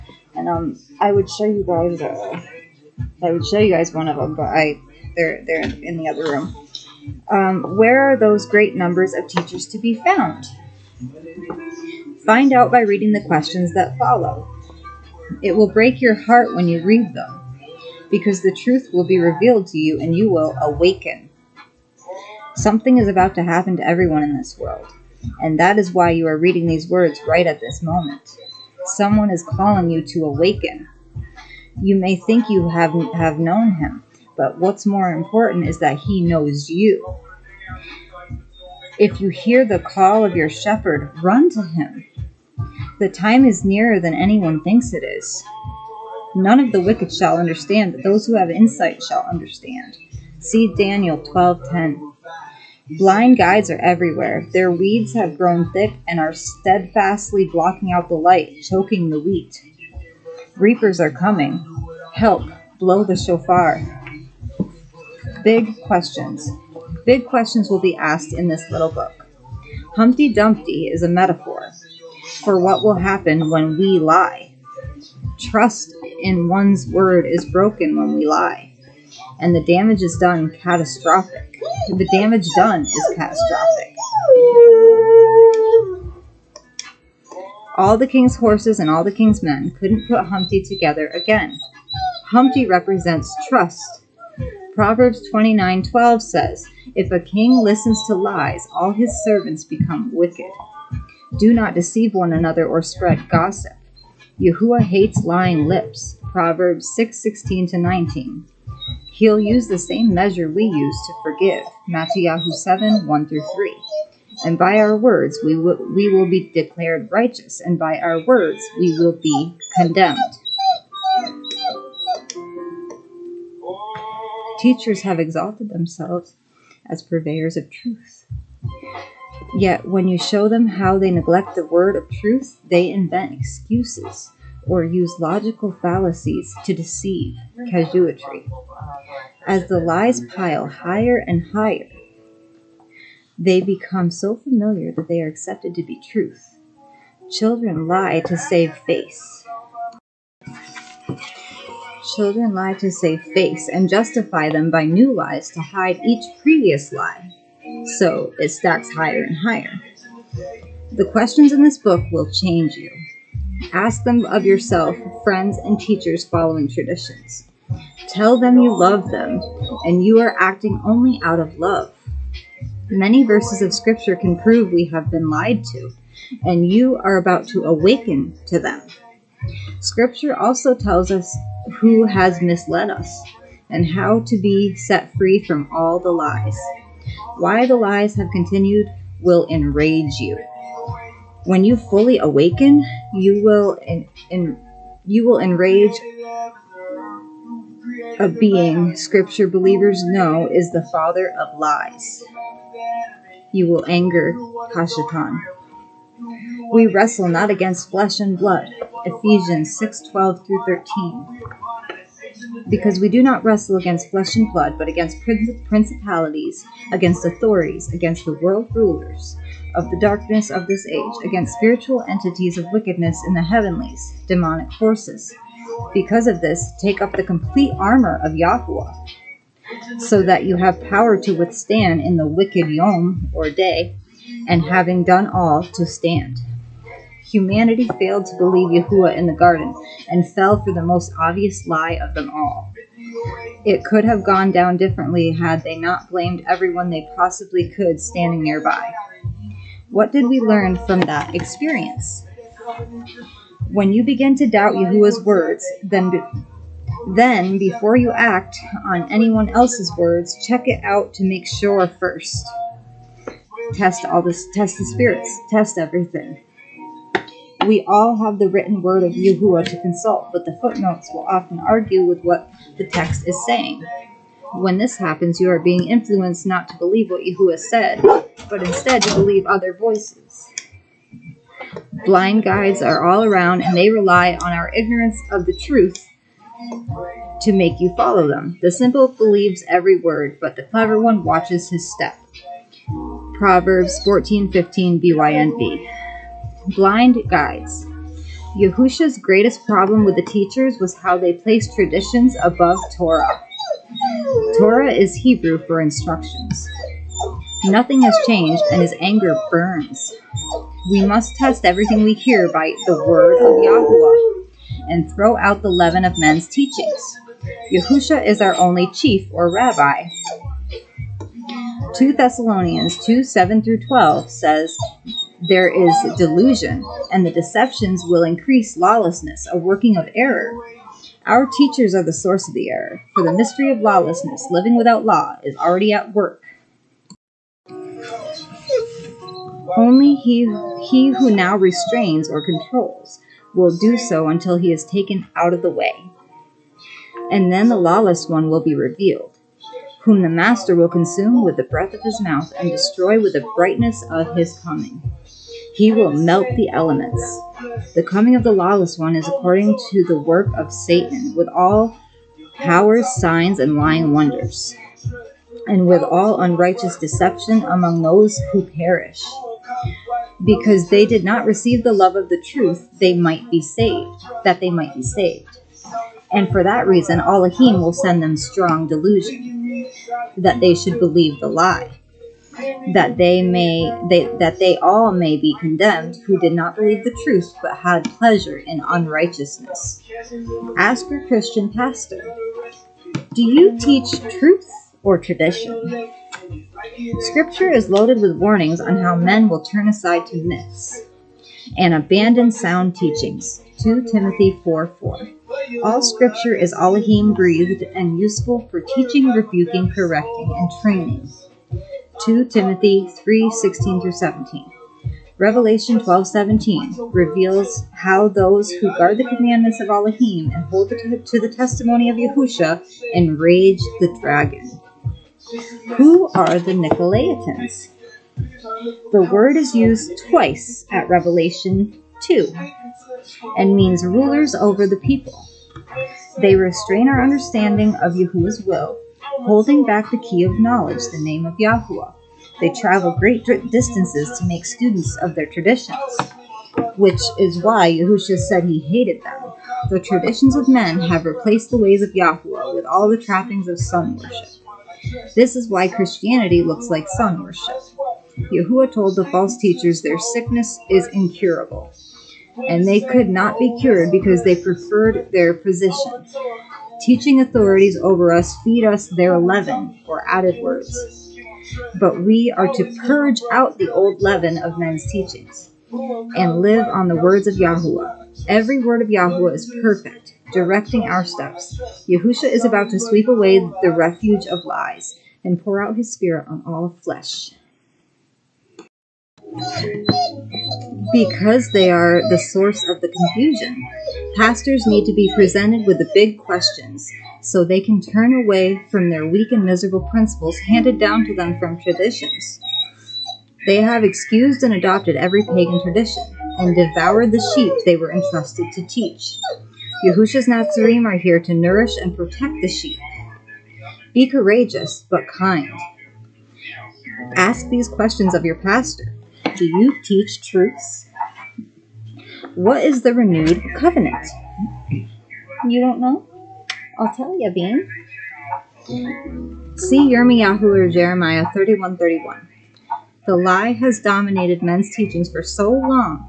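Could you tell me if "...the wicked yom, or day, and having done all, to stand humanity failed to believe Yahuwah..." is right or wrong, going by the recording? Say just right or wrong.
right.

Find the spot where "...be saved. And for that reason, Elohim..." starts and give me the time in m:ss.
6:14.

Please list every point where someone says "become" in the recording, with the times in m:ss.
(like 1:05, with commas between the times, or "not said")
1:39, 2:23.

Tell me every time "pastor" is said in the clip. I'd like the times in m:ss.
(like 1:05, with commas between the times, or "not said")
6:31, 8:14, 8:38.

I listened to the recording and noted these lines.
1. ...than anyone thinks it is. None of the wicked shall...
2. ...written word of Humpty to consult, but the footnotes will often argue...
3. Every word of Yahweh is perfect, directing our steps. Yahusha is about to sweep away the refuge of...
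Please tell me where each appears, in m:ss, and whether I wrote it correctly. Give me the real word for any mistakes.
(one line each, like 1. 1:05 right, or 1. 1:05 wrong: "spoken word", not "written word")
1. 0:43 right
2. 4:28 wrong: "Yahuwah", not "Humpty"
3. 7:58 right.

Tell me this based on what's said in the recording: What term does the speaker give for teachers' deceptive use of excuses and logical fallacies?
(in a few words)
Casuistry.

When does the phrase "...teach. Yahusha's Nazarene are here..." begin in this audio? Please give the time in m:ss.
8:28.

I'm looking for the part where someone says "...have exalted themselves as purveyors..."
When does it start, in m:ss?
2:05.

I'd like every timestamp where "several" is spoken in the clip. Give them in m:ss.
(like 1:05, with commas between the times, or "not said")
not said.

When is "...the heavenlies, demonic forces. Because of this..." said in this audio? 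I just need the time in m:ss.
3:43.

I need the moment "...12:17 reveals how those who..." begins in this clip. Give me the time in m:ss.
6:55.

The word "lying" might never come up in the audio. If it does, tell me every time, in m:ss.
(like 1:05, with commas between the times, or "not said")
1:45, 6:03.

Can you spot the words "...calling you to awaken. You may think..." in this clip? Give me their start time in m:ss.
0:29.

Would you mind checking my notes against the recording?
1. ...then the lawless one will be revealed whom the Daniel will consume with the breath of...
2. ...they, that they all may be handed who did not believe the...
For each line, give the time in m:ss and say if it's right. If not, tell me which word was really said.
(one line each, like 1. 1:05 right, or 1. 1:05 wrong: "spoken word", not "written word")
1. 5:47 wrong: "Master", not "Daniel"
2. 6:24 wrong: "condemned", not "handed".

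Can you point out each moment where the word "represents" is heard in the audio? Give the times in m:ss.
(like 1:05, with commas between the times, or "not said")
1:32.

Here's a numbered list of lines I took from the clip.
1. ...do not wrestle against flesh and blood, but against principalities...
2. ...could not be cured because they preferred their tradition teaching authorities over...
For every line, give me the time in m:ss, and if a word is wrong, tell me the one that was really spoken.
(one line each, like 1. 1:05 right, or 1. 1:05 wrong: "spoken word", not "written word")
1. 3:33 right
2. 7:43 wrong: "position", not "tradition".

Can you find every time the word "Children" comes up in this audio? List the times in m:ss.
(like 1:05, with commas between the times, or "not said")
2:27, 2:32.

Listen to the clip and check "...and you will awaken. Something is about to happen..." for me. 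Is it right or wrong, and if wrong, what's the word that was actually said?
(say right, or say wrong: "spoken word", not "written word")
right.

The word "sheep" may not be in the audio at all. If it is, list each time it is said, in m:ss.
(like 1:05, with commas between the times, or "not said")
8:27, 8:32.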